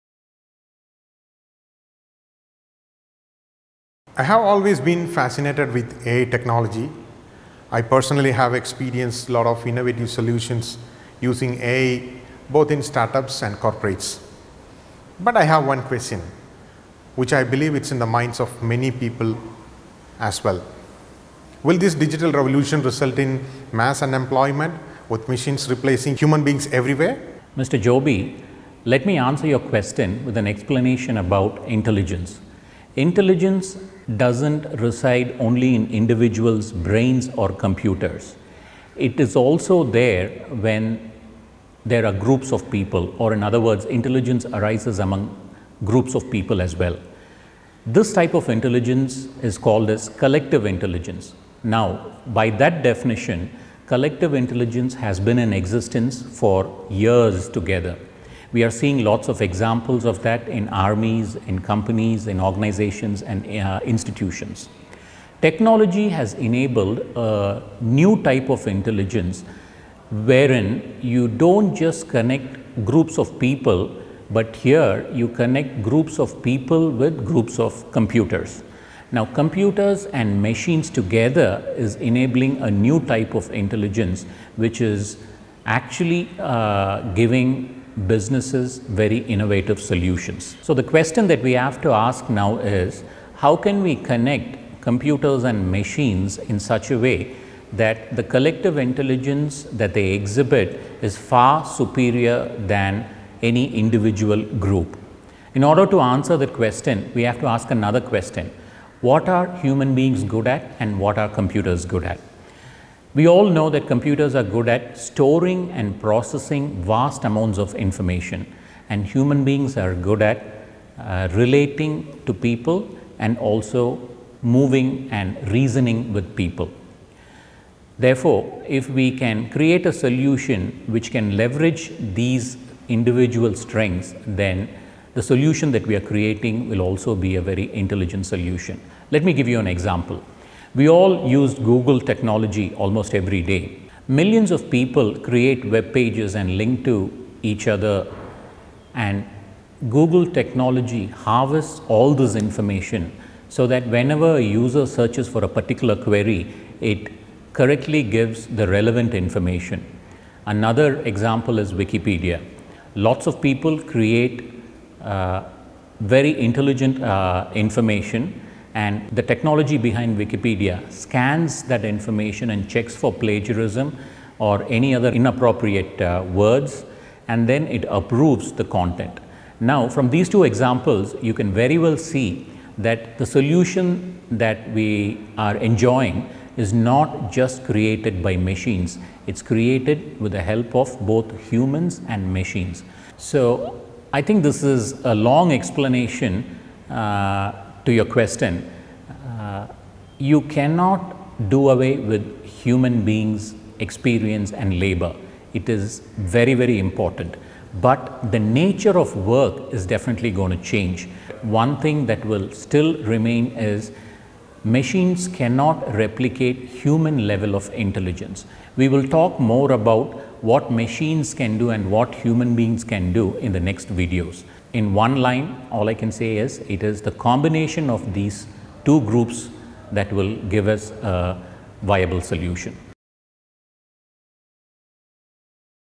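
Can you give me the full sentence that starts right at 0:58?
We are seeing lots of examples of that in armies, in companies, in organizations and uh, institutions.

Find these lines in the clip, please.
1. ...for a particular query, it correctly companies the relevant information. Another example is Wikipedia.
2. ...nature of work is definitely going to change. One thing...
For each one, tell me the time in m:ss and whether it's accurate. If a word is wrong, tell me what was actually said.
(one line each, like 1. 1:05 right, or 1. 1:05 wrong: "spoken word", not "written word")
1. 2:35 wrong: "gives", not "companies"
2. 3:28 right.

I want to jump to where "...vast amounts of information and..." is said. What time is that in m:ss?
1:56.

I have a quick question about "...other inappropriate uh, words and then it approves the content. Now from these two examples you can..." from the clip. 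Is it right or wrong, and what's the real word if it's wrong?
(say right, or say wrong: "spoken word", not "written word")
right.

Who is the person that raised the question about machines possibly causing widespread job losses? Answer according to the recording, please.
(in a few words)
Mr. Joby.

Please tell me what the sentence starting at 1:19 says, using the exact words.
Now computers and machines together is enabling a new type of intelligence which is actually uh, giving businesses very innovative solutions.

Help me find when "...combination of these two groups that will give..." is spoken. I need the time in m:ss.
3:47.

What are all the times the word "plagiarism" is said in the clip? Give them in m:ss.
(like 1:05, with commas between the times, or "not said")
2:53.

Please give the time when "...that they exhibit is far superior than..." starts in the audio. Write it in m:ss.
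1:39.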